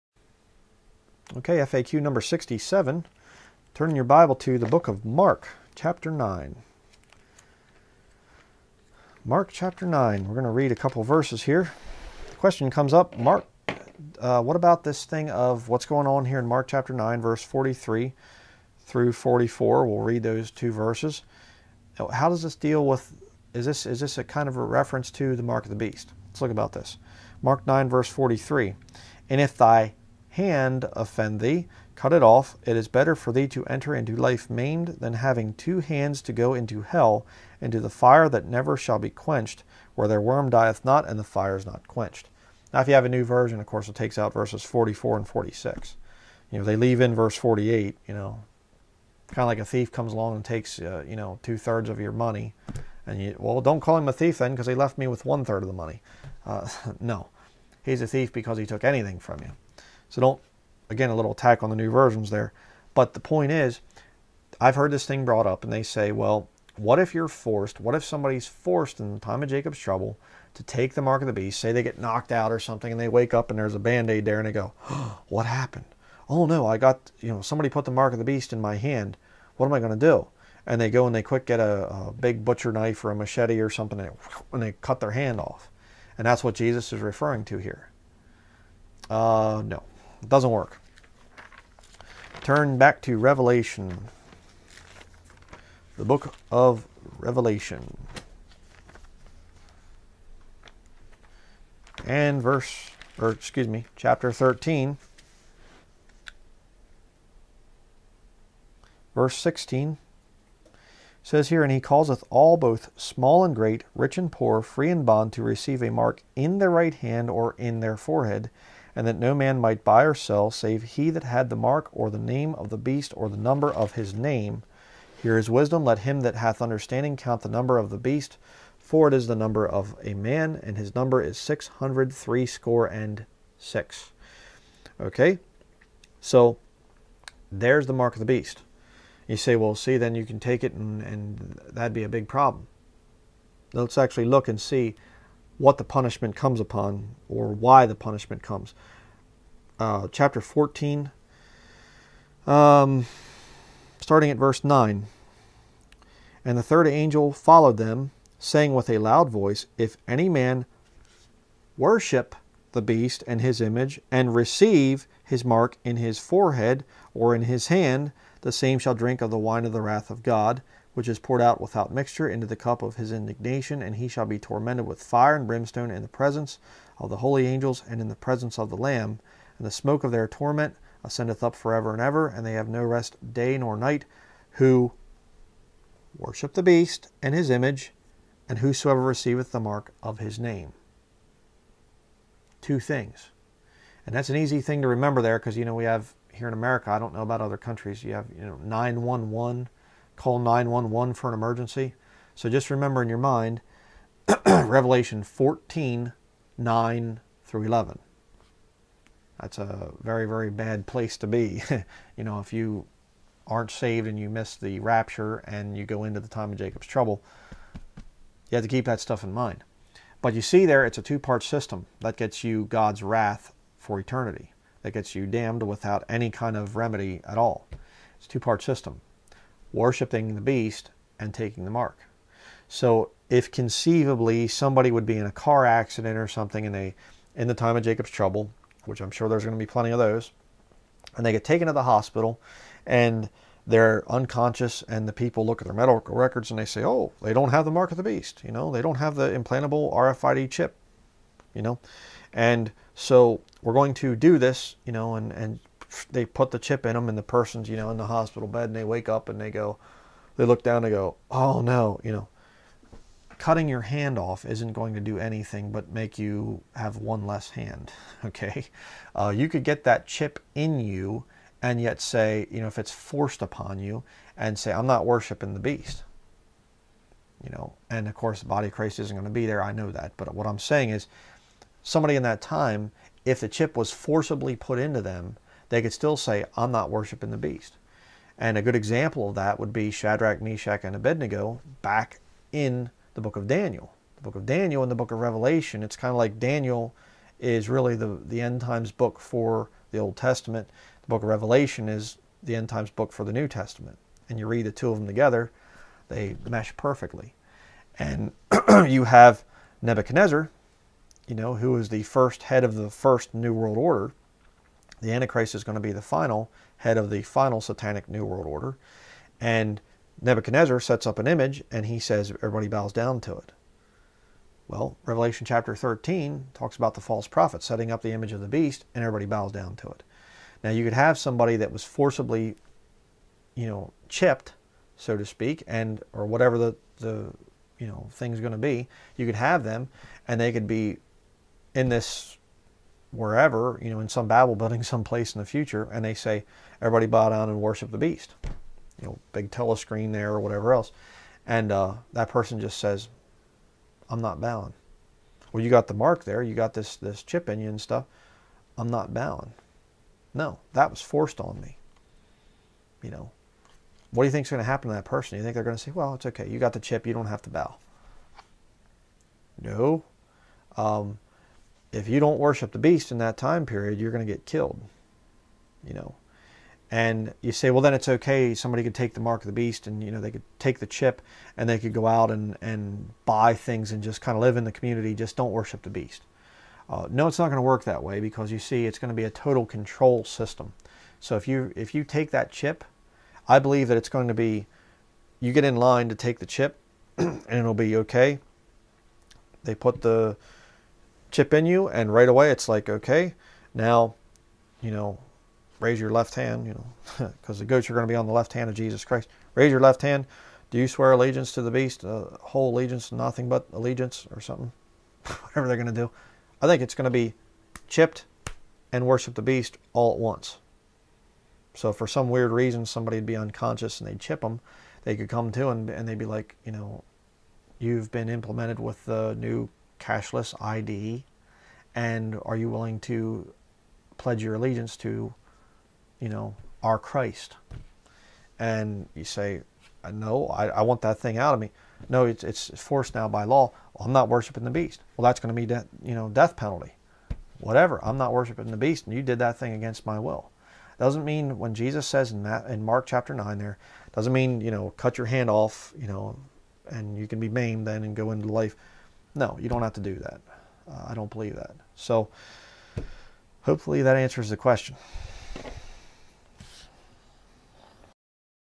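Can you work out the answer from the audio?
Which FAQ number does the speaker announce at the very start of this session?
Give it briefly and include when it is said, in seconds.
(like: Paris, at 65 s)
67, at 2 s.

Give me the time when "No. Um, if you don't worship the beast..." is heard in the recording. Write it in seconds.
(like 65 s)
369 s.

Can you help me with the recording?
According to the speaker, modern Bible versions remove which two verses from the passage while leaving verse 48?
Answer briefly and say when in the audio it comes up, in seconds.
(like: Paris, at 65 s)
44 and 46, at 44 s.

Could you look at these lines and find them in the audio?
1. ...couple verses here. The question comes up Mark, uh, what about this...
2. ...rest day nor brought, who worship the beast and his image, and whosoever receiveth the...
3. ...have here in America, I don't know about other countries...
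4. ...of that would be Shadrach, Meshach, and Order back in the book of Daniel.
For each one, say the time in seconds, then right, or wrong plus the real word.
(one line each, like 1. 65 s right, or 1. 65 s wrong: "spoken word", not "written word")
1. 10 s right
2. 182 s wrong: "night", not "brought"
3. 195 s right
4. 289 s wrong: "Abednego", not "Order".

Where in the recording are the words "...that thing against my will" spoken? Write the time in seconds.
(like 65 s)
449 s.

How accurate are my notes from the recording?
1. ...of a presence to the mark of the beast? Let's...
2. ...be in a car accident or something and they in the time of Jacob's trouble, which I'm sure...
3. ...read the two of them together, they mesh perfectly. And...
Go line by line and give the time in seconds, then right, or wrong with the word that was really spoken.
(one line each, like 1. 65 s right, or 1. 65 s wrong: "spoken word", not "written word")
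1. 24 s wrong: "reference", not "presence"
2. 235 s right
3. 304 s right.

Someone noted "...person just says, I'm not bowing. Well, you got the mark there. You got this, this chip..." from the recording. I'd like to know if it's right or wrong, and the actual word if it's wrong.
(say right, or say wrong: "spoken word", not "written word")
right.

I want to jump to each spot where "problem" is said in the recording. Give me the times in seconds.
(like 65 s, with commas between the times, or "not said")
142 s.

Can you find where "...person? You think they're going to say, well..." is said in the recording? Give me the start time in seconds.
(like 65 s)
365 s.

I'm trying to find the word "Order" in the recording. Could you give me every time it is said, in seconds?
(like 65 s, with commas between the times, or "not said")
313 s, 318 s.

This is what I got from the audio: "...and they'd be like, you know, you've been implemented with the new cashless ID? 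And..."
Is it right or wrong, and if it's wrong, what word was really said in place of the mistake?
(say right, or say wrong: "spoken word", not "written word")
right.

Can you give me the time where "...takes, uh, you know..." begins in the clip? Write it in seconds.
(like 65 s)
50 s.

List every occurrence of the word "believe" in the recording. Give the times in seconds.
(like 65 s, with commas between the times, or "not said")
393 s, 461 s.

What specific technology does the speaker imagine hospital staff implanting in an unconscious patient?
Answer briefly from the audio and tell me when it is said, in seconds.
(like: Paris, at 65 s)
implantable RFID chip, at 249 s.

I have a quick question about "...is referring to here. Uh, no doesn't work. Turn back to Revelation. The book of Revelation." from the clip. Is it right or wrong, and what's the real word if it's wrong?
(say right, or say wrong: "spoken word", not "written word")
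right.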